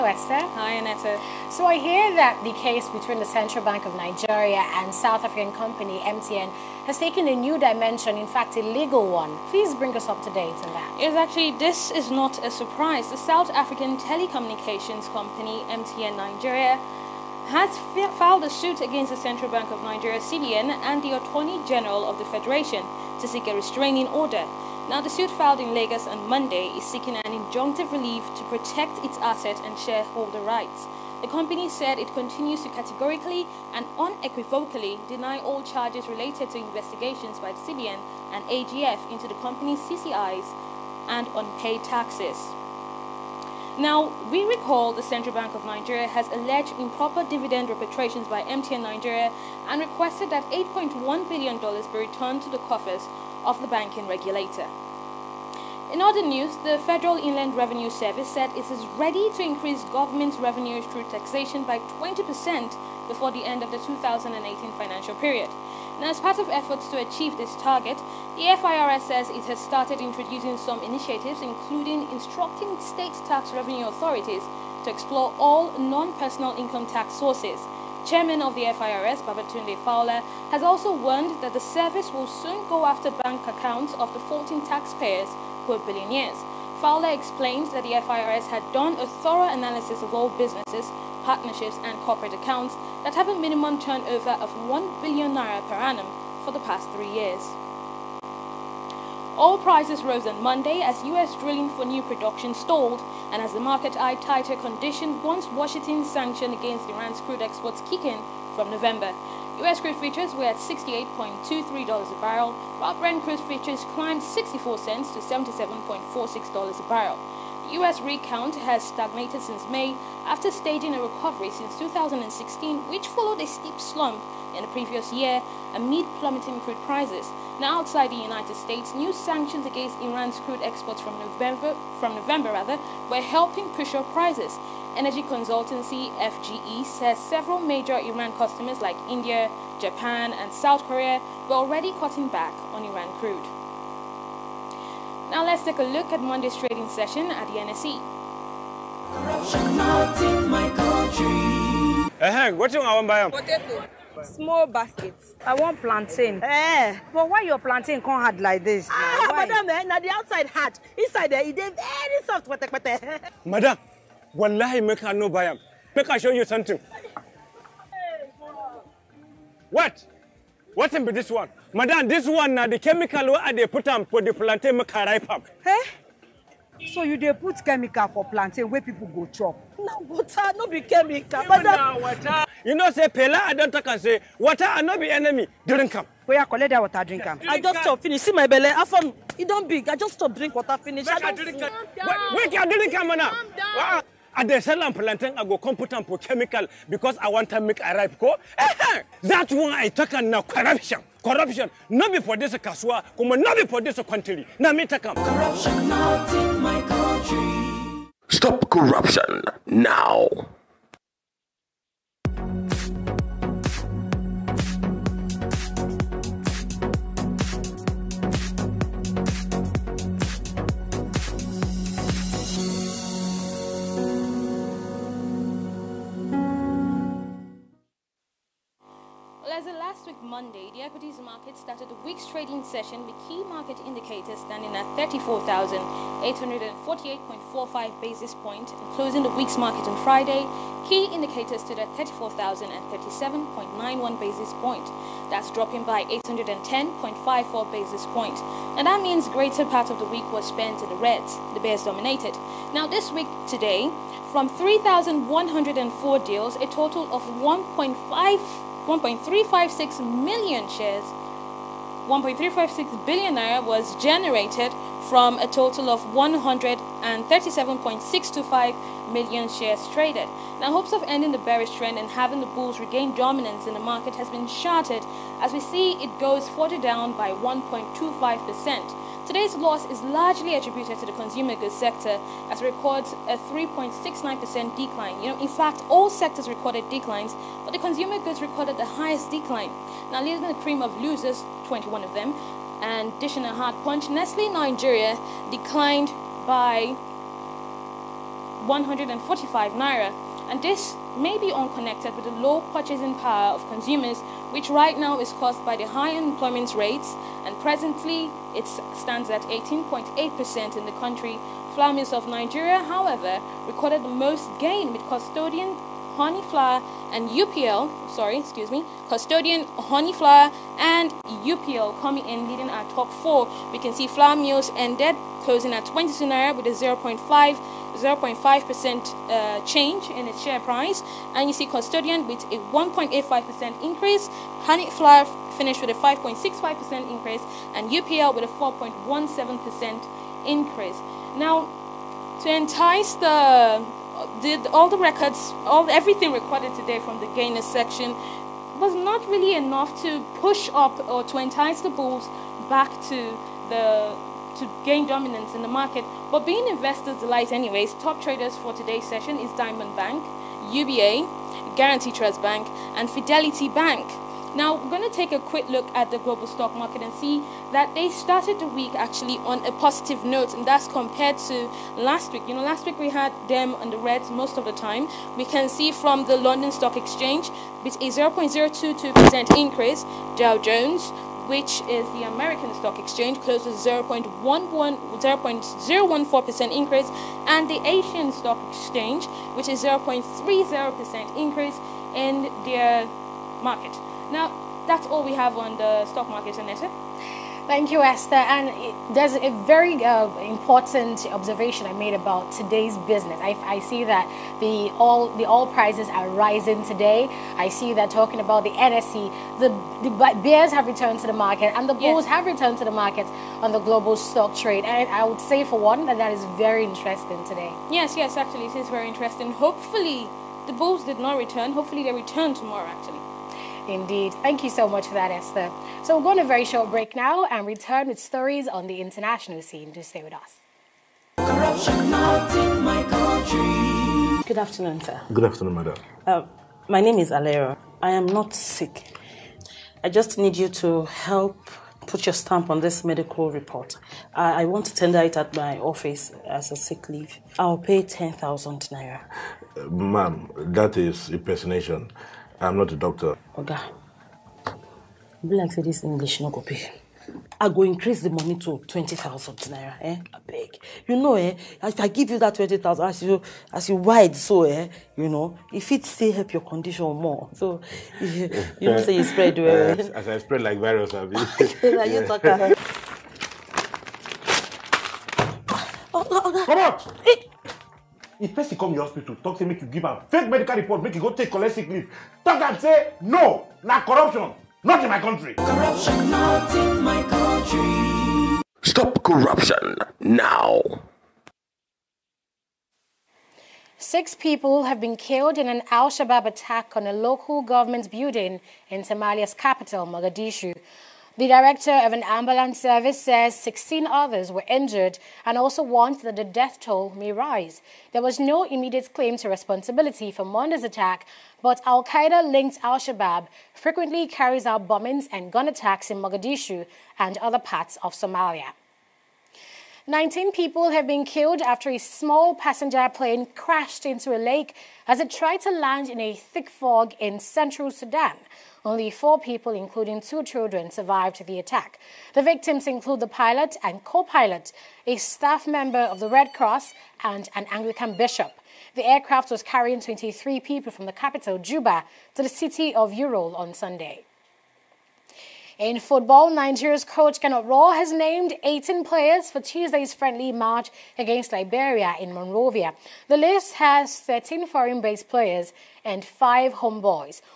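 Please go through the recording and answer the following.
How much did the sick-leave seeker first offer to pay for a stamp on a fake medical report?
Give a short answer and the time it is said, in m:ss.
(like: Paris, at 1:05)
10,000 naira, at 7:28.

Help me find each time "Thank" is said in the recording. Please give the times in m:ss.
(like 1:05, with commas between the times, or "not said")
6:37, 7:04.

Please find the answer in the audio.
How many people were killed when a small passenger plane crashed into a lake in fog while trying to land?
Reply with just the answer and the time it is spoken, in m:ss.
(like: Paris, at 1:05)
19, at 8:40.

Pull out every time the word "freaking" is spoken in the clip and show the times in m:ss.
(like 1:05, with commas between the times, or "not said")
not said.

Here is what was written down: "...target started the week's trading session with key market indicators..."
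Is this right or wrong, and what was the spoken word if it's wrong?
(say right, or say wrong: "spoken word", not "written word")
wrong: "market", not "target".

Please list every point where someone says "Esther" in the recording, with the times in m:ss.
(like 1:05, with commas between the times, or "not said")
0:00, 6:37, 7:05.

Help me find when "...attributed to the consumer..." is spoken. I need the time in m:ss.
4:40.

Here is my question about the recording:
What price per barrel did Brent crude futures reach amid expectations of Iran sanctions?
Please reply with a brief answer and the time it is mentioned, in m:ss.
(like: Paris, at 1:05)
$77.46, at 1:55.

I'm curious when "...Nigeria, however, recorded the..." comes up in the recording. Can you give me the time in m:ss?
5:12.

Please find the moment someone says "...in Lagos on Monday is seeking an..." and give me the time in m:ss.
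0:25.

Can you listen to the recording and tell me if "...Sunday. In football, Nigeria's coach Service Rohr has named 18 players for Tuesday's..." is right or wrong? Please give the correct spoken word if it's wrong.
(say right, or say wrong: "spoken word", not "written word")
wrong: "Gernot", not "Service".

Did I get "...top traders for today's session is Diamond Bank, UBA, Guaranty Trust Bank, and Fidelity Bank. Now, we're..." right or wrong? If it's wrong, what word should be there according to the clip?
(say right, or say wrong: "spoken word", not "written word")
right.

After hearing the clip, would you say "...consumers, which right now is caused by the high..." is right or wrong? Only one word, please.
right.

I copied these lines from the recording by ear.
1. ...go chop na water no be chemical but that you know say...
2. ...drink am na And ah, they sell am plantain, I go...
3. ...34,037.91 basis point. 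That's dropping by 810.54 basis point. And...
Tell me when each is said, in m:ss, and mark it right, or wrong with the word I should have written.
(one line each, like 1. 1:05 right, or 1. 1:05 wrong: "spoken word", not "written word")
1. 2:59 right
2. 3:12 right
3. 4:01 right.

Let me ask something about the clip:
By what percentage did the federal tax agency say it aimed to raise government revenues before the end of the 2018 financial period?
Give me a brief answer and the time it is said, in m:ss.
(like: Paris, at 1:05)
20%, at 1:01.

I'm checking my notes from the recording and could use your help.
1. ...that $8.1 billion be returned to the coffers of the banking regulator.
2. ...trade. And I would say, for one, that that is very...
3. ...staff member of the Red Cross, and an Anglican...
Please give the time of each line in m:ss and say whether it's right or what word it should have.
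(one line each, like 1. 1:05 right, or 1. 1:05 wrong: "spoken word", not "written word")
1. 0:50 right
2. 6:54 right
3. 8:55 right.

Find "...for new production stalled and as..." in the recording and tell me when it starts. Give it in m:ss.
1:41.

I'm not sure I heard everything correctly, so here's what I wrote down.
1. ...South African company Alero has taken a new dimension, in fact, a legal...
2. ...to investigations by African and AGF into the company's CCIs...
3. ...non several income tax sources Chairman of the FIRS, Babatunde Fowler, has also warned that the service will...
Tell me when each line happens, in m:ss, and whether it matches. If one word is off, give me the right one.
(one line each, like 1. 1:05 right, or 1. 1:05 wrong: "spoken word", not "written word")
1. 0:04 wrong: "MTN", not "Alero"
2. 0:36 wrong: "CBN", not "African"
3. 1:15 wrong: "personal", not "several".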